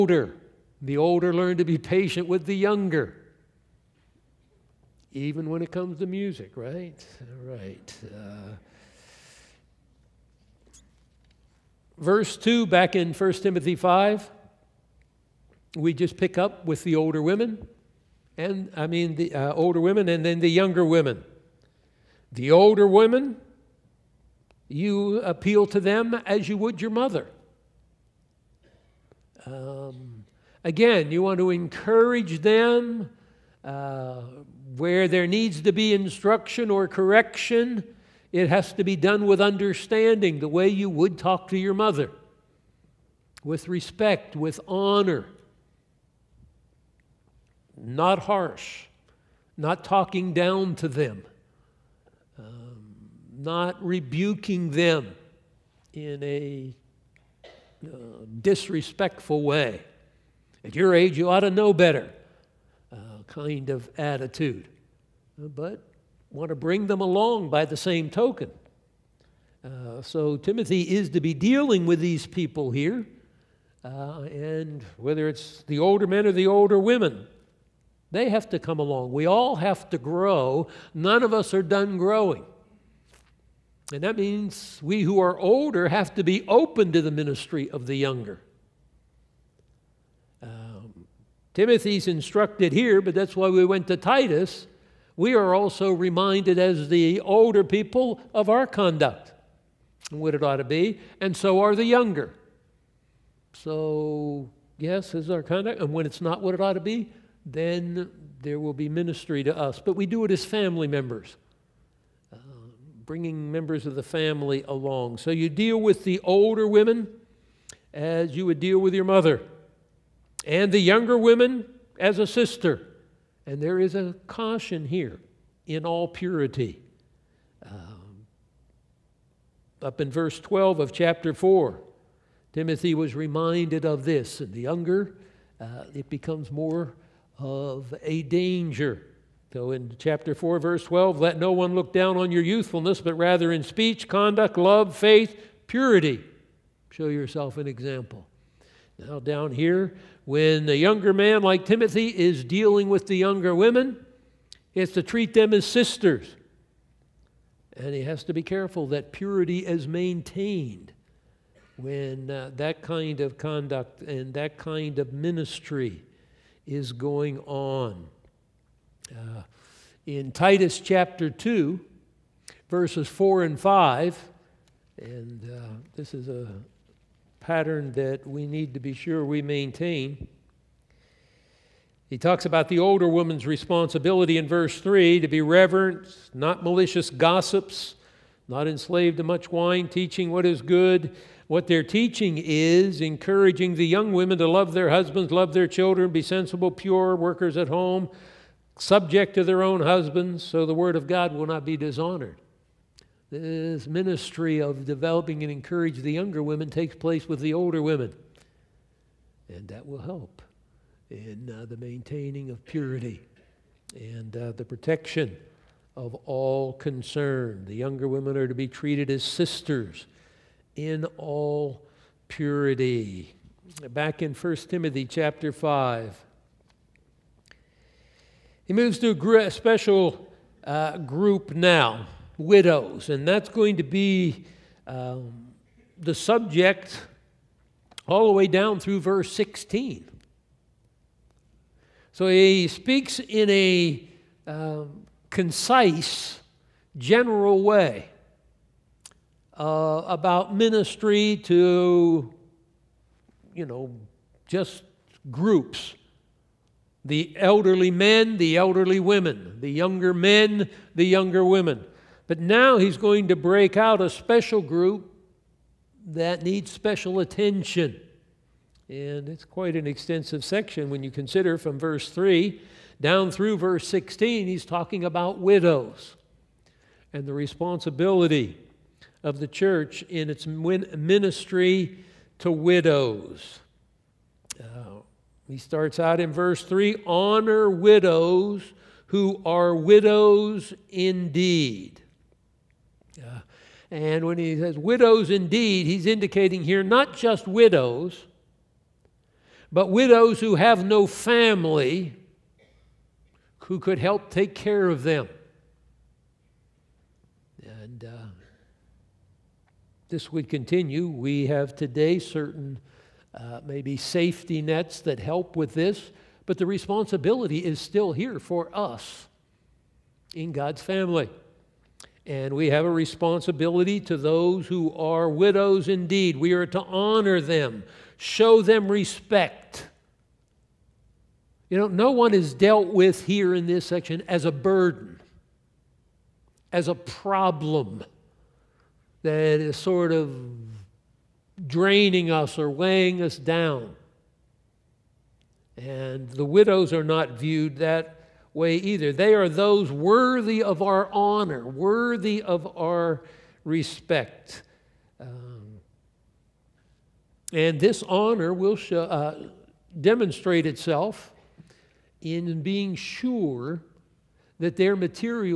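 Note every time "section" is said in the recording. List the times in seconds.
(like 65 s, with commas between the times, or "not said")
270 s, 333 s.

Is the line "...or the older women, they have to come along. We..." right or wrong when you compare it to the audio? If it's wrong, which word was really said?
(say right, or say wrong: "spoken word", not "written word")
right.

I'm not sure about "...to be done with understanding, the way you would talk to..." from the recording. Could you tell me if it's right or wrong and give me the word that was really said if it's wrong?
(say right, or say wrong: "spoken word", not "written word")
right.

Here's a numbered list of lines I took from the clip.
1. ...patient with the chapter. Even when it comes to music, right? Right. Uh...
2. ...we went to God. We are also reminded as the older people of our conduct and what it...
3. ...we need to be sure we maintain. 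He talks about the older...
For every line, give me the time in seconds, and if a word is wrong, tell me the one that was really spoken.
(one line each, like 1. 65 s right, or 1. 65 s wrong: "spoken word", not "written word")
1. 1 s wrong: "younger", not "chapter"
2. 93 s wrong: "Titus", not "God"
3. 178 s right.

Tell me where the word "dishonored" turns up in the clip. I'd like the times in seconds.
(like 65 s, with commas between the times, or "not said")
201 s.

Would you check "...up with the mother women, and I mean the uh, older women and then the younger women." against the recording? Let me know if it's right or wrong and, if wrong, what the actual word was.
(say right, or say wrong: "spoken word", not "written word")
wrong: "older", not "mother".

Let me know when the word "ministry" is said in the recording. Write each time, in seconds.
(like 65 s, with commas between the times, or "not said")
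87 s, 108 s, 165 s, 203 s, 250 s, 280 s.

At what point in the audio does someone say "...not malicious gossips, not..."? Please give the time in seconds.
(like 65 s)
186 s.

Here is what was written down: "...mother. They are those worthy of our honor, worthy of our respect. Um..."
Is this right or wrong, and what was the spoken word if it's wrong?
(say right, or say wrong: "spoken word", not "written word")
wrong: "either", not "mother".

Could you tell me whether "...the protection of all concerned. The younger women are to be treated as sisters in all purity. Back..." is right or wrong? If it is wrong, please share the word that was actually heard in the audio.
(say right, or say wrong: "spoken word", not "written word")
right.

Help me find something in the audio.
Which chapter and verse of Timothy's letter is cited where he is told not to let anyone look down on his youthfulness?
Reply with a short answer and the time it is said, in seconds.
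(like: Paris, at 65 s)
Chapter 4, verse 12, at 139 s.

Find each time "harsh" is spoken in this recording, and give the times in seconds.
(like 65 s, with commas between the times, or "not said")
48 s.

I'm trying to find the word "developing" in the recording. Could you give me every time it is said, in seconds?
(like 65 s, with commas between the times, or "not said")
204 s.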